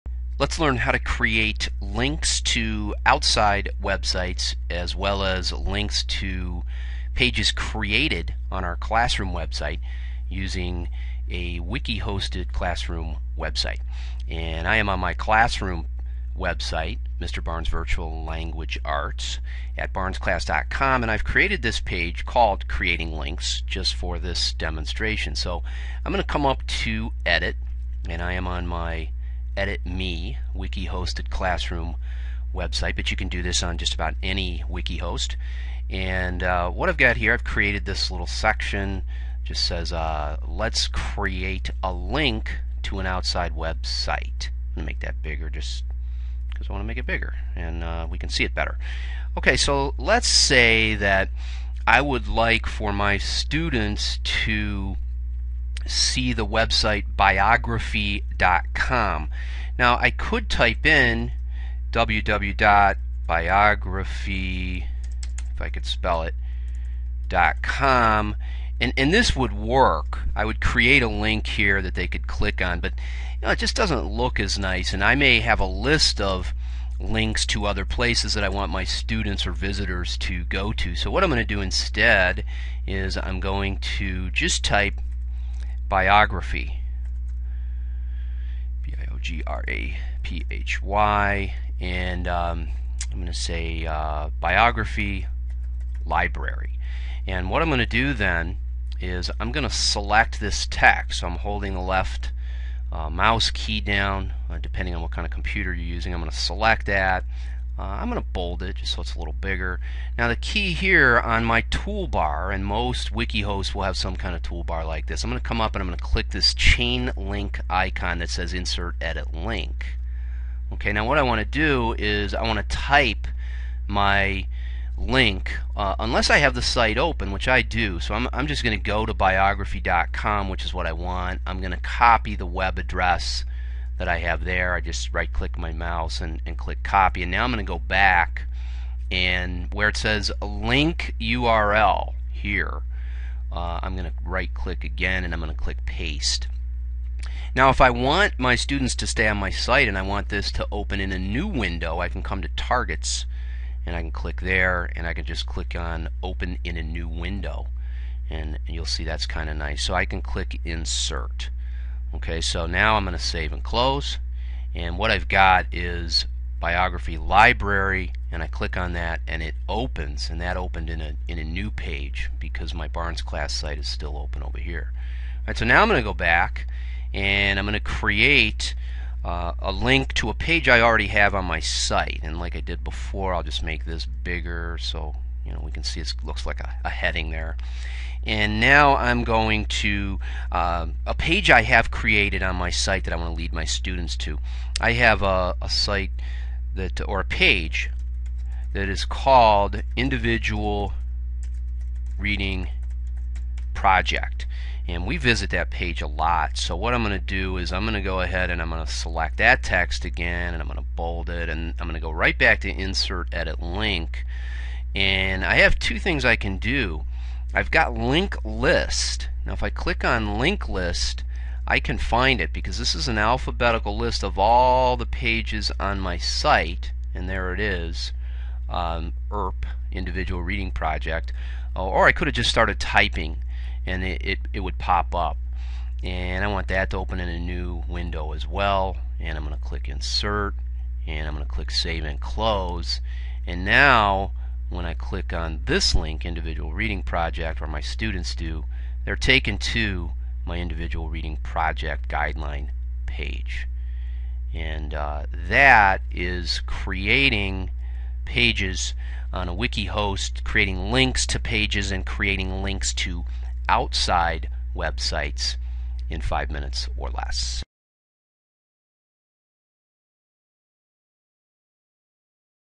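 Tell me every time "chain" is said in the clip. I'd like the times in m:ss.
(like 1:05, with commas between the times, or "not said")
1:56.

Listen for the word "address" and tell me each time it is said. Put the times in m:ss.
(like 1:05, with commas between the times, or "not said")
2:12.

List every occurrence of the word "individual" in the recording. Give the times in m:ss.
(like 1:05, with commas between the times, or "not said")
3:19, 3:49, 4:06, 4:10.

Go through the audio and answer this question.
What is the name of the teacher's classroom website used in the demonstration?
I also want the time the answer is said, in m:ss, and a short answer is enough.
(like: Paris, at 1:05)
Mr. Barnes Virtual Language Arts, at 0:17.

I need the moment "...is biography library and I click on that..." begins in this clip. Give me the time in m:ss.
2:45.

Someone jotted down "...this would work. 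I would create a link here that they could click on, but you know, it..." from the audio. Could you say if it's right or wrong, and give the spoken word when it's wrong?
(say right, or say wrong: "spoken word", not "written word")
right.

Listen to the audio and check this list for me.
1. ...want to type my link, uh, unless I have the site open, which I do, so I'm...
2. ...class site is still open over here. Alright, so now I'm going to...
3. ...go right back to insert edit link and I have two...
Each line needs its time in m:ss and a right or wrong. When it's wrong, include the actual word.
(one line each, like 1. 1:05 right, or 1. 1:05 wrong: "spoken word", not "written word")
1. 2:02 right
2. 2:53 right
3. 3:31 right.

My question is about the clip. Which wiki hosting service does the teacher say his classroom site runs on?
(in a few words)
EditMe.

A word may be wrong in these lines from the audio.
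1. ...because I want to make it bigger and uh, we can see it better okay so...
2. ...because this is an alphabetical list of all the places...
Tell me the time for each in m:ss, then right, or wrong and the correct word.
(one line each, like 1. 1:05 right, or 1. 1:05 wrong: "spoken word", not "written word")
1. 0:46 right
2. 3:42 wrong: "pages", not "places".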